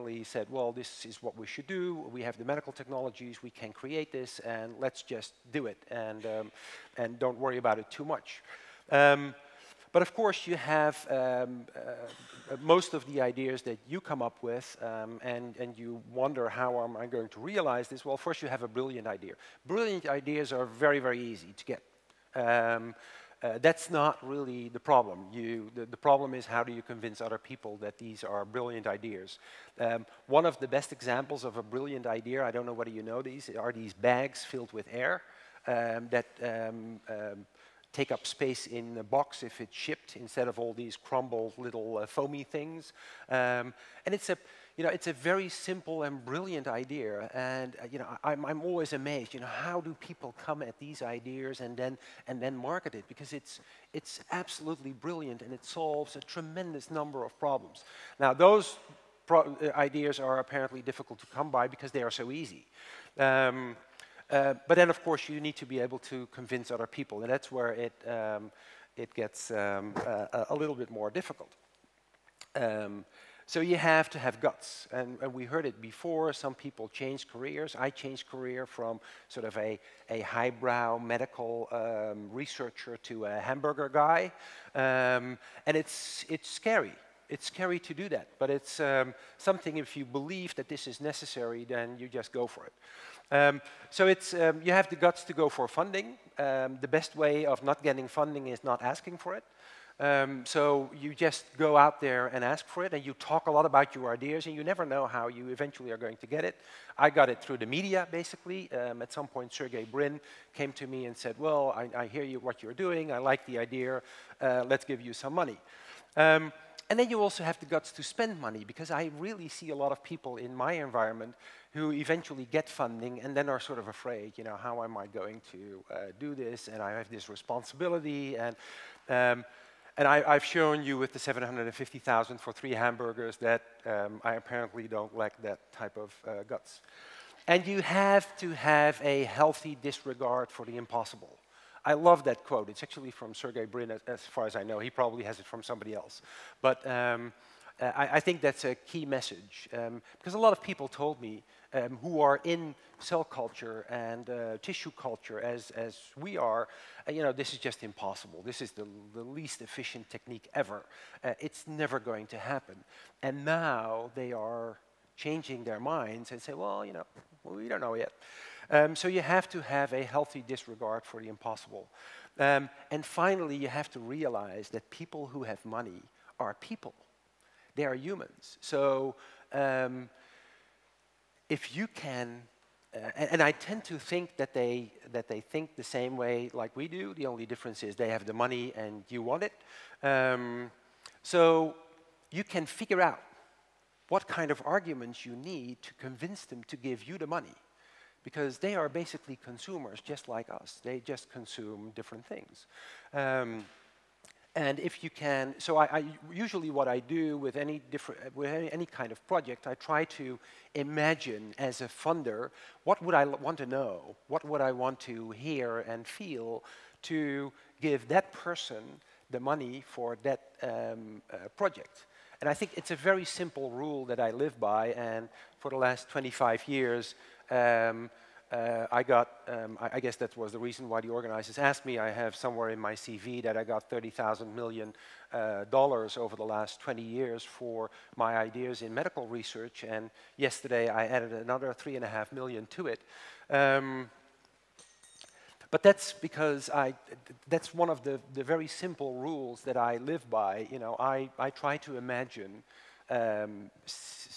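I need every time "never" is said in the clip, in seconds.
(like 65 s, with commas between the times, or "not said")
104 s, 161 s.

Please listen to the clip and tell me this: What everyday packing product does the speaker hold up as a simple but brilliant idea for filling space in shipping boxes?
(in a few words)
Bags filled with air.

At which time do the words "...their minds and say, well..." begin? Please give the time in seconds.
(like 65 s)
165 s.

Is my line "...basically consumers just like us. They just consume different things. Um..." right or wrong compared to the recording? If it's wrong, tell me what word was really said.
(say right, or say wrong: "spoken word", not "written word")
right.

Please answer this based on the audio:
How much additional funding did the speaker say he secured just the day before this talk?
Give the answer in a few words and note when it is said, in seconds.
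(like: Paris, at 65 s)
3.5 million, at 241 s.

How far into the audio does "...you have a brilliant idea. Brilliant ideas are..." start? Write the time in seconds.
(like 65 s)
18 s.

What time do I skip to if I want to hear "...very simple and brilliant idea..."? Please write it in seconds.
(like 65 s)
45 s.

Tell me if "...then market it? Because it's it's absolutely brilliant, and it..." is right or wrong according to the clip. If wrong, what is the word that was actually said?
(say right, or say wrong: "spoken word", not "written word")
right.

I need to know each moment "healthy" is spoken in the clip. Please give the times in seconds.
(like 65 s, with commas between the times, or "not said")
139 s, 170 s.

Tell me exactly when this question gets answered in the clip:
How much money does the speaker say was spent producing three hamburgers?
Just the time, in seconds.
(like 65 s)
131 s.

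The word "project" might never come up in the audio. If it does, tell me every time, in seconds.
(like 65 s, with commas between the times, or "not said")
209 s, 221 s.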